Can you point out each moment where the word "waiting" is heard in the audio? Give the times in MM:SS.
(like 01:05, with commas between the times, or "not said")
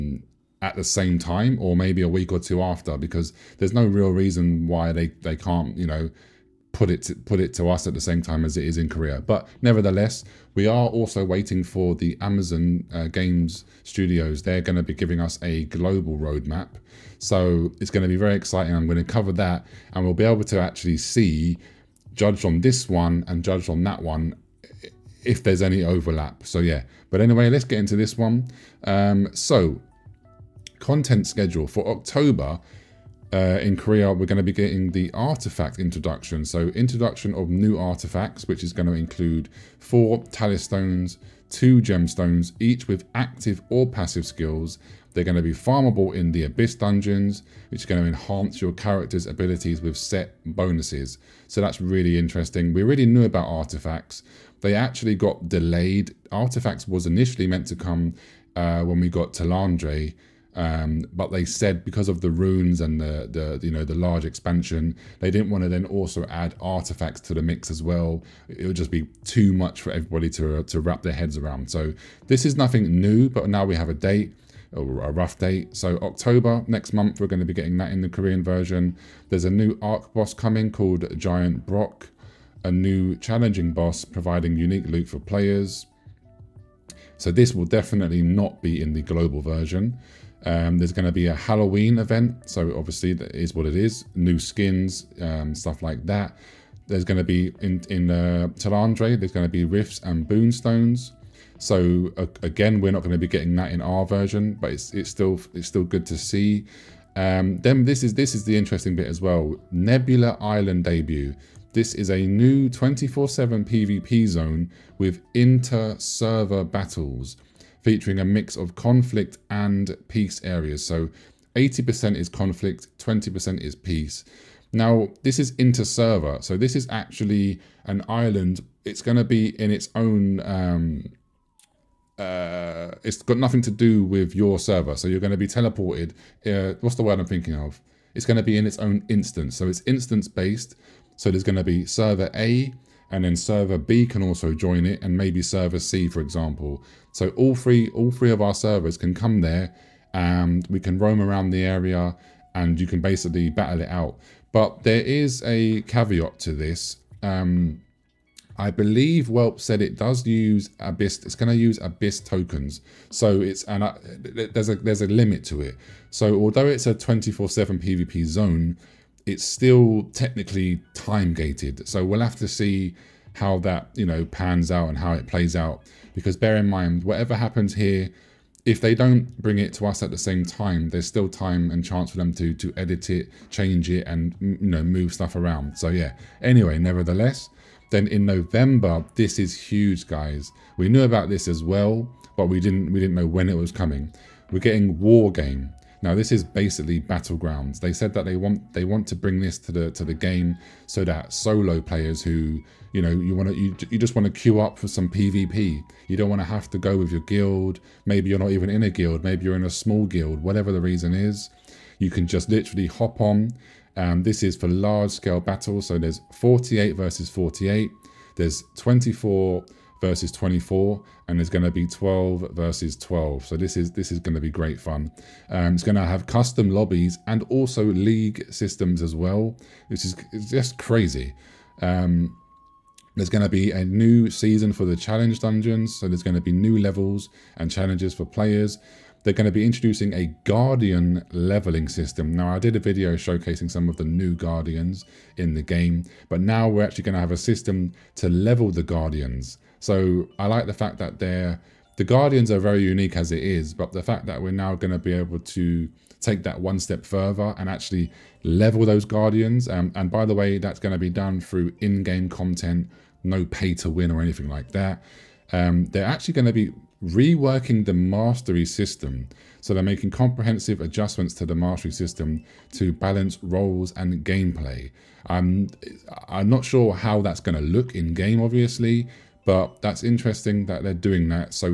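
00:11.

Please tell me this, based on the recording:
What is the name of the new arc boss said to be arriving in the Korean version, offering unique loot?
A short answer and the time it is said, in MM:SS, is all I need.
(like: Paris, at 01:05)
Giant Brock, at 01:21.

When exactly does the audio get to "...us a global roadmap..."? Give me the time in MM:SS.
00:15.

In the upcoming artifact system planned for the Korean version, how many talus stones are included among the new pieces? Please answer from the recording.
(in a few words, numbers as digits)
4.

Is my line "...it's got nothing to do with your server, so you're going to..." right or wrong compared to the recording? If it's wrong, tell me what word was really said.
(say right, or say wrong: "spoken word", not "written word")
right.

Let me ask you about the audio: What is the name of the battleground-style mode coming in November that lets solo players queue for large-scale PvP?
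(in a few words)
War Game.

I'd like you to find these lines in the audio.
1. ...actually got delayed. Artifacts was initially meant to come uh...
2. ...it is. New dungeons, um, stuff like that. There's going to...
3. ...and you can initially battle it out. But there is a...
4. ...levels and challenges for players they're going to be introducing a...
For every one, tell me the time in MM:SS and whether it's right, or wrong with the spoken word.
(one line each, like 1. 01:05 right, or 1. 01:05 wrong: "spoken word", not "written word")
1. 00:54 right
2. 01:33 wrong: "skins", not "dungeons"
3. 02:32 wrong: "basically", not "initially"
4. 03:56 right.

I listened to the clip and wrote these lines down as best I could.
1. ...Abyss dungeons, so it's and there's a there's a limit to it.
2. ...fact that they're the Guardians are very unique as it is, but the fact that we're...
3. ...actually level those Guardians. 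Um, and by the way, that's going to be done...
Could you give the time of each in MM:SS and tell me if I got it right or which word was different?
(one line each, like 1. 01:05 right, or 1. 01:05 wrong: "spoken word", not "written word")
1. 02:41 wrong: "tokens", not "dungeons"
2. 04:10 right
3. 04:17 right.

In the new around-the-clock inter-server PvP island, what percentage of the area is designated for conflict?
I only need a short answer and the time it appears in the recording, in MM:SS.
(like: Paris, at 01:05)
80%, at 02:01.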